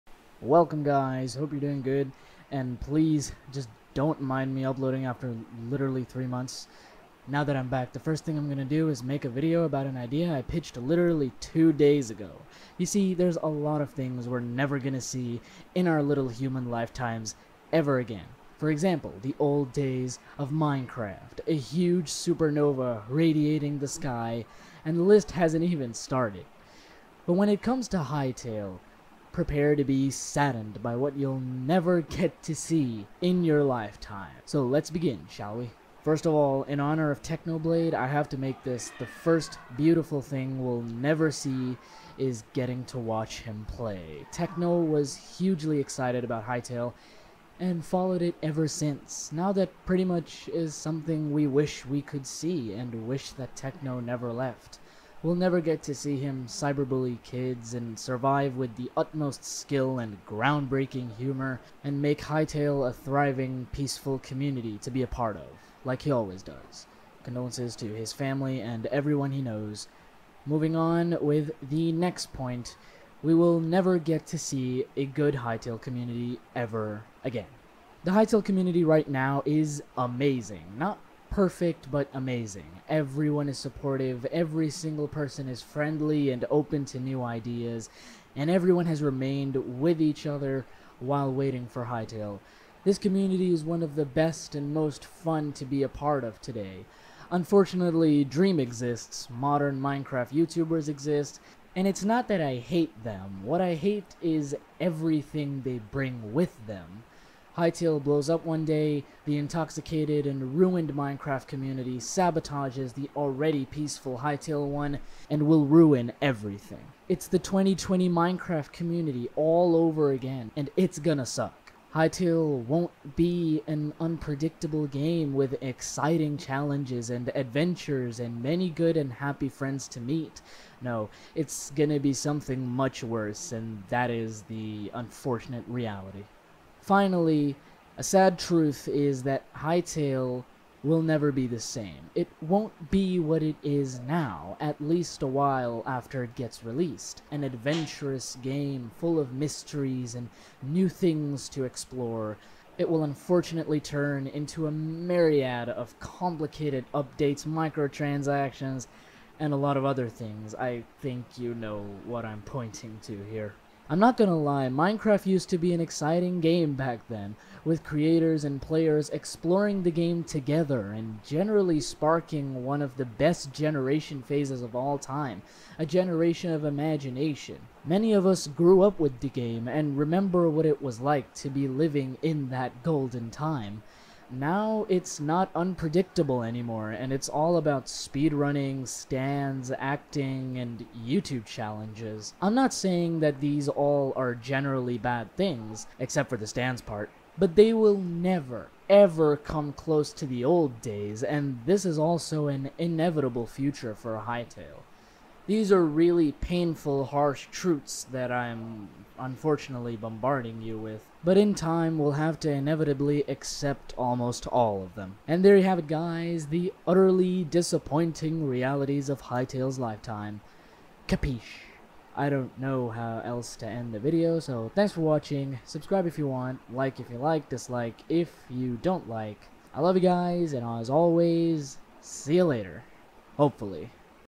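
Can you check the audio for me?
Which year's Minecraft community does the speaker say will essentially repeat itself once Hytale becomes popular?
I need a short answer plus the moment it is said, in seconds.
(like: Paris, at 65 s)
2020, at 117 s.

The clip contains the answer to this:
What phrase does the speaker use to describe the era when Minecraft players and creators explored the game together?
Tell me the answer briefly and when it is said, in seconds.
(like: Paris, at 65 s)
a generation of imagination, at 175 s.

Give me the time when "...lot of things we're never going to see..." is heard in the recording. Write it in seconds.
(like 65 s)
13 s.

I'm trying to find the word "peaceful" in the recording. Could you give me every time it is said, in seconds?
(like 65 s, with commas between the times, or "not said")
63 s, 113 s.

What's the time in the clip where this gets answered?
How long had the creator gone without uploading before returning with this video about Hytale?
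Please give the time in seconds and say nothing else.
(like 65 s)
6 s.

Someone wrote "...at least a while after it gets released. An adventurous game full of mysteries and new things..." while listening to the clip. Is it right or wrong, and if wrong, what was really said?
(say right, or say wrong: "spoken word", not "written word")
right.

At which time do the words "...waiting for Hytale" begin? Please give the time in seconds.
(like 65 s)
91 s.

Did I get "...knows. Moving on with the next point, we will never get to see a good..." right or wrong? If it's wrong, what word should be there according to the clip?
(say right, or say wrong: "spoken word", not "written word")
right.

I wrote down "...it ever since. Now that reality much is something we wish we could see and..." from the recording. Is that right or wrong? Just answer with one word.
wrong.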